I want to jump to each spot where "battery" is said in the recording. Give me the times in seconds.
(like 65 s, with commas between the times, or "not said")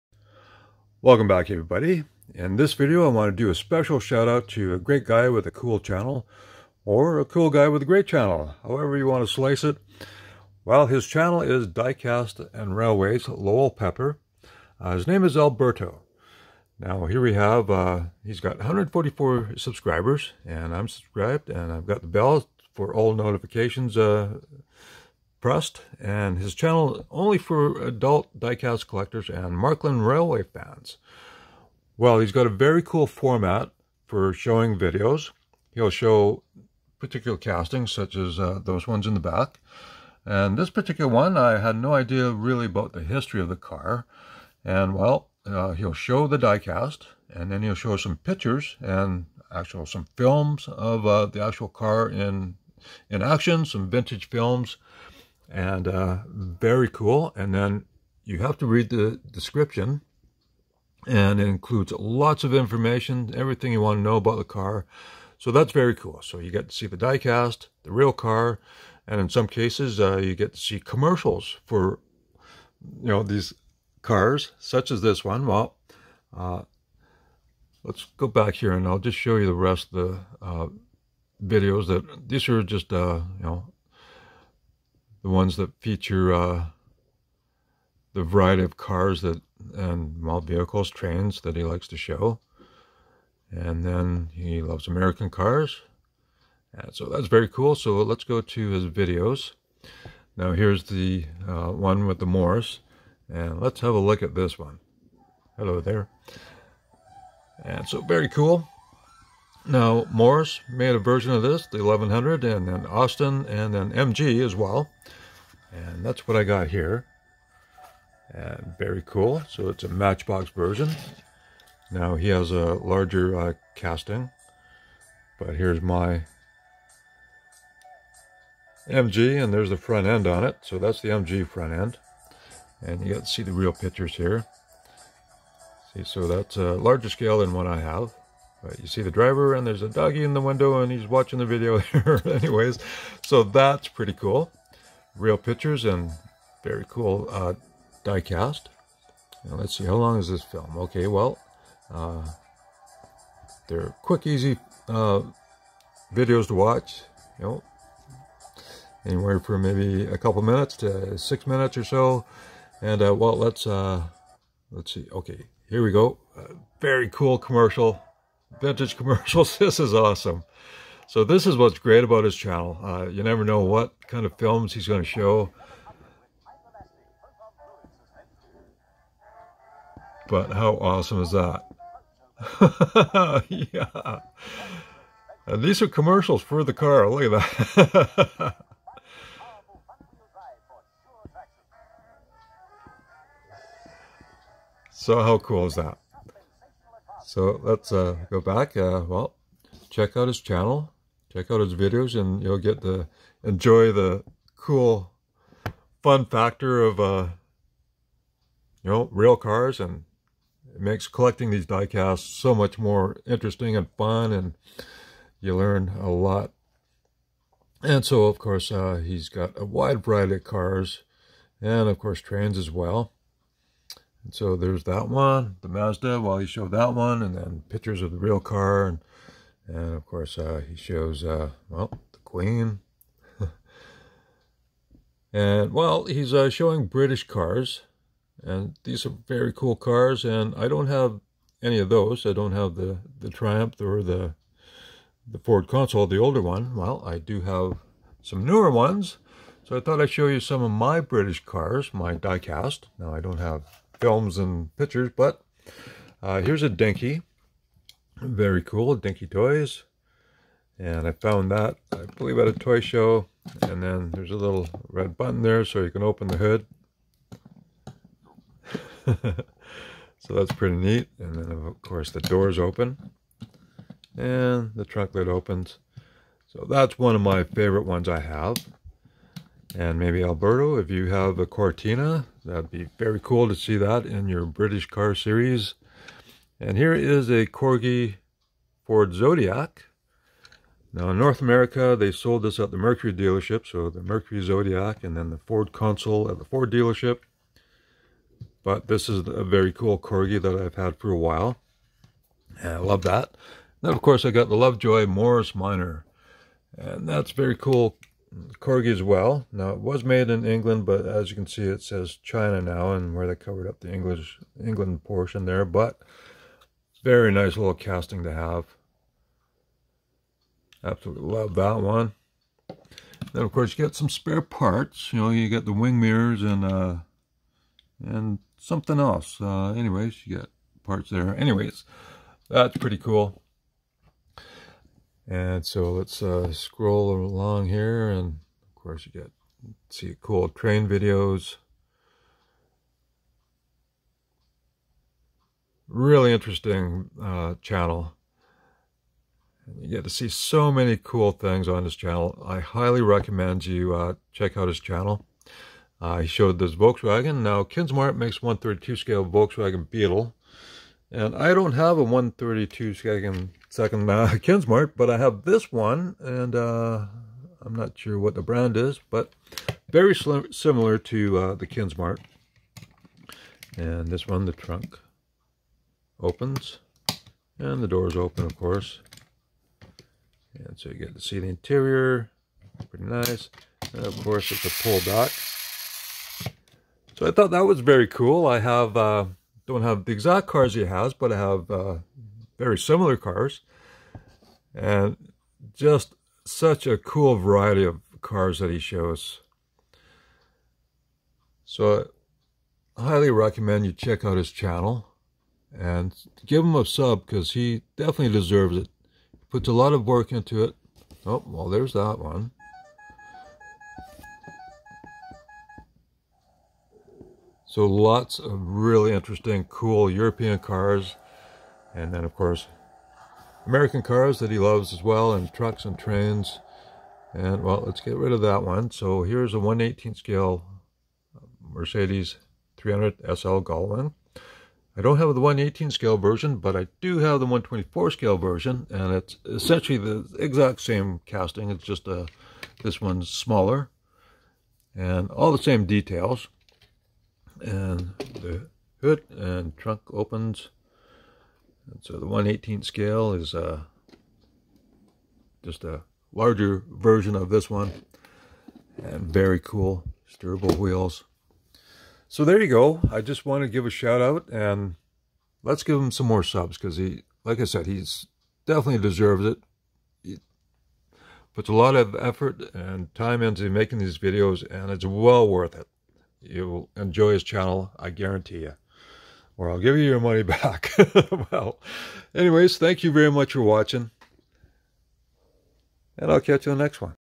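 not said.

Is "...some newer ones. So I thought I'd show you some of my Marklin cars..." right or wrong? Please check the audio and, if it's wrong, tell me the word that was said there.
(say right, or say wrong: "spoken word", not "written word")
wrong: "British", not "Marklin".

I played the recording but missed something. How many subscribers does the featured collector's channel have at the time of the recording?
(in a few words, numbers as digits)
144.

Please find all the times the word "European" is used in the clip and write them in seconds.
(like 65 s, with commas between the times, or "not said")
420 s.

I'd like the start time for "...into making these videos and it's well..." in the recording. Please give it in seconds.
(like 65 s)
473 s.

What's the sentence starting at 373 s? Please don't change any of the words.
And this one, the trunk opens.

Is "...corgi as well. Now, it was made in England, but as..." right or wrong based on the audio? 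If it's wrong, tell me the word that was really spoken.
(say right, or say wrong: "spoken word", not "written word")
right.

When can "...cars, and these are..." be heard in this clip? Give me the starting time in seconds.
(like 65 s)
237 s.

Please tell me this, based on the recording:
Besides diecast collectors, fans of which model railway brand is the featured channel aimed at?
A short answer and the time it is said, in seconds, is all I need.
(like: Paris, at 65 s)
Marklin, at 29 s.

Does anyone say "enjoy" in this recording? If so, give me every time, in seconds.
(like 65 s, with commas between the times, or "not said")
203 s, 476 s.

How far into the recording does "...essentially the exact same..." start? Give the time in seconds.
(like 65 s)
439 s.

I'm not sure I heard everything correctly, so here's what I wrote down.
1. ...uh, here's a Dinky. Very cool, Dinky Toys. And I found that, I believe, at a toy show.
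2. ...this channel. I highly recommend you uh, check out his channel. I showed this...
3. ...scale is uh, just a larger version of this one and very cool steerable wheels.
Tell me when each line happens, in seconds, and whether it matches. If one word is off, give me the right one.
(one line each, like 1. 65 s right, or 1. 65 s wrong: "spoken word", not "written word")
1. 256 s right
2. 351 s right
3. 452 s right.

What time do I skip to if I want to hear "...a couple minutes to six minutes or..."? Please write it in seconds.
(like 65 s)
160 s.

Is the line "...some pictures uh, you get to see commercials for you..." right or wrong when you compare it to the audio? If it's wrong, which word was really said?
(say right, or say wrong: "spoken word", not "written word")
wrong: "cases", not "pictures".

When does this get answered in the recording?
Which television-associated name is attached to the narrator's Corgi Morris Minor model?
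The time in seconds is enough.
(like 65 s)
304 s.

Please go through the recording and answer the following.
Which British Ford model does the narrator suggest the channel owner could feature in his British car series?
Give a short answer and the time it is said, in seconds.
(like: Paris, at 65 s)
Cortina, at 281 s.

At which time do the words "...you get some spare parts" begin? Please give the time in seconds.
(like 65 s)
323 s.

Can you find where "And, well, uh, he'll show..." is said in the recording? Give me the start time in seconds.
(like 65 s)
44 s.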